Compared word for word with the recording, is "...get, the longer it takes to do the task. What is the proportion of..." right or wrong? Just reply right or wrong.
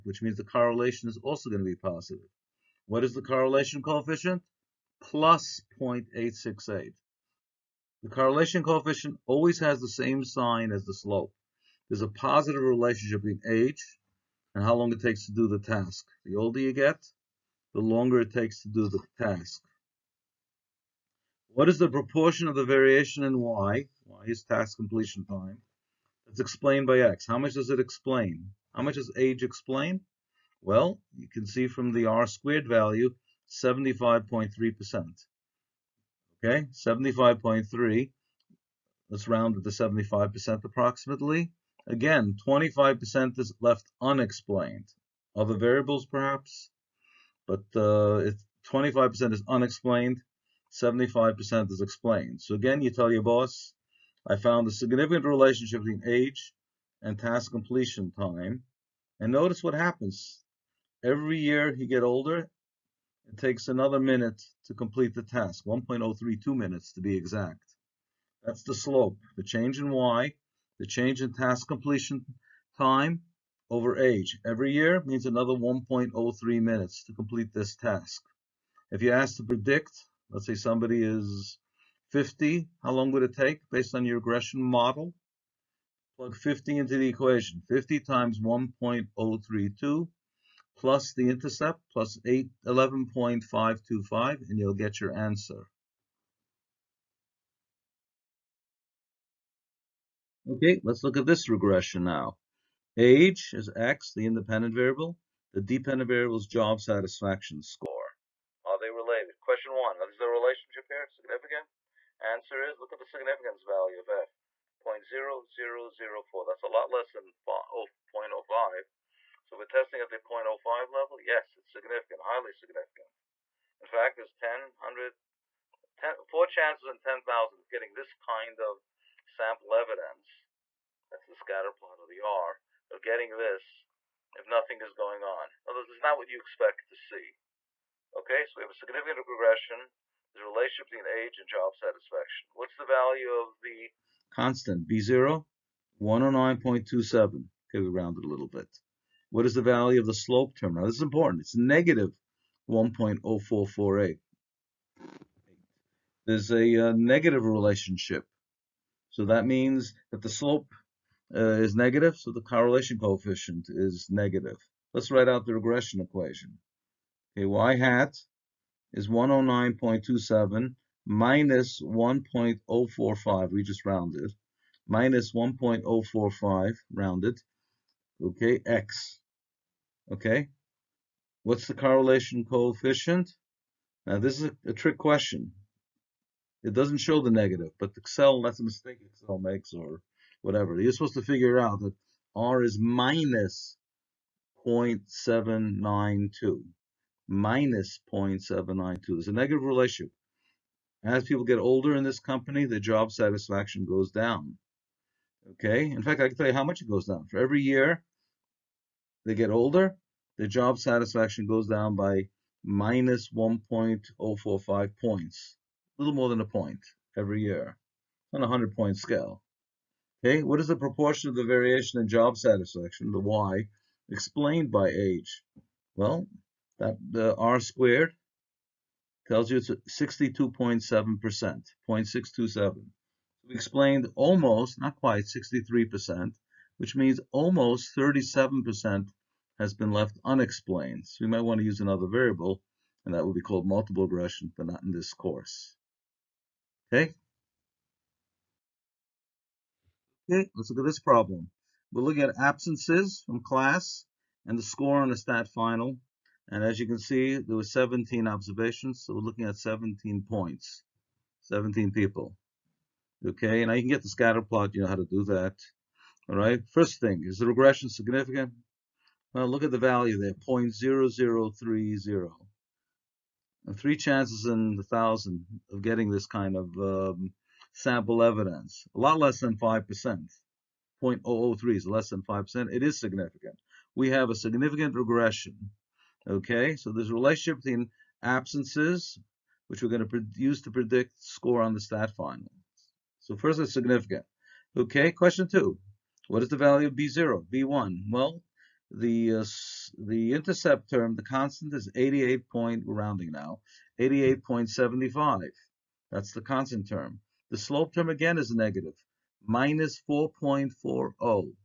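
right.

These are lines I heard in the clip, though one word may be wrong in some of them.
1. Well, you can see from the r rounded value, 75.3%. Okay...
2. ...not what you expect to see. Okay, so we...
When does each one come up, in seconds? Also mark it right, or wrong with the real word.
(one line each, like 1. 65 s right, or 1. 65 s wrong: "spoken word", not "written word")
1. 30 s wrong: "squared", not "rounded"
2. 135 s right.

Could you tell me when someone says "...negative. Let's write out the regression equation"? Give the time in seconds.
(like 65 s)
164 s.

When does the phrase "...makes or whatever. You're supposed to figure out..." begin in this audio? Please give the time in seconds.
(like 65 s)
189 s.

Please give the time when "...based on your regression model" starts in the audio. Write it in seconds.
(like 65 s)
83 s.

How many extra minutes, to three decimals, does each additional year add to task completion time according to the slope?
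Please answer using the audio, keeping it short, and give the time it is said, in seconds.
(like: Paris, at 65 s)
1.032, at 65 s.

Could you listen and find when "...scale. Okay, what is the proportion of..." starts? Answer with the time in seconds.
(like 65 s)
218 s.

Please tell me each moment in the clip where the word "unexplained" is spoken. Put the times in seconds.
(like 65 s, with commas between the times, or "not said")
44 s, 49 s, 240 s.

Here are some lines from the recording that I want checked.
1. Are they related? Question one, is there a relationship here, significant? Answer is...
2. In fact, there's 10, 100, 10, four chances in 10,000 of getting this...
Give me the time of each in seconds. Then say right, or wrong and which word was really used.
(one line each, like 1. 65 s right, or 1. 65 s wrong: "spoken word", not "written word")
1. 108 s right
2. 123 s right.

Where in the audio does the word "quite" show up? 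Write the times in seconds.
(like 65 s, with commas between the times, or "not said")
234 s.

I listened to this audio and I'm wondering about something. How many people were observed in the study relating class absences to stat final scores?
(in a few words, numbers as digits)
17.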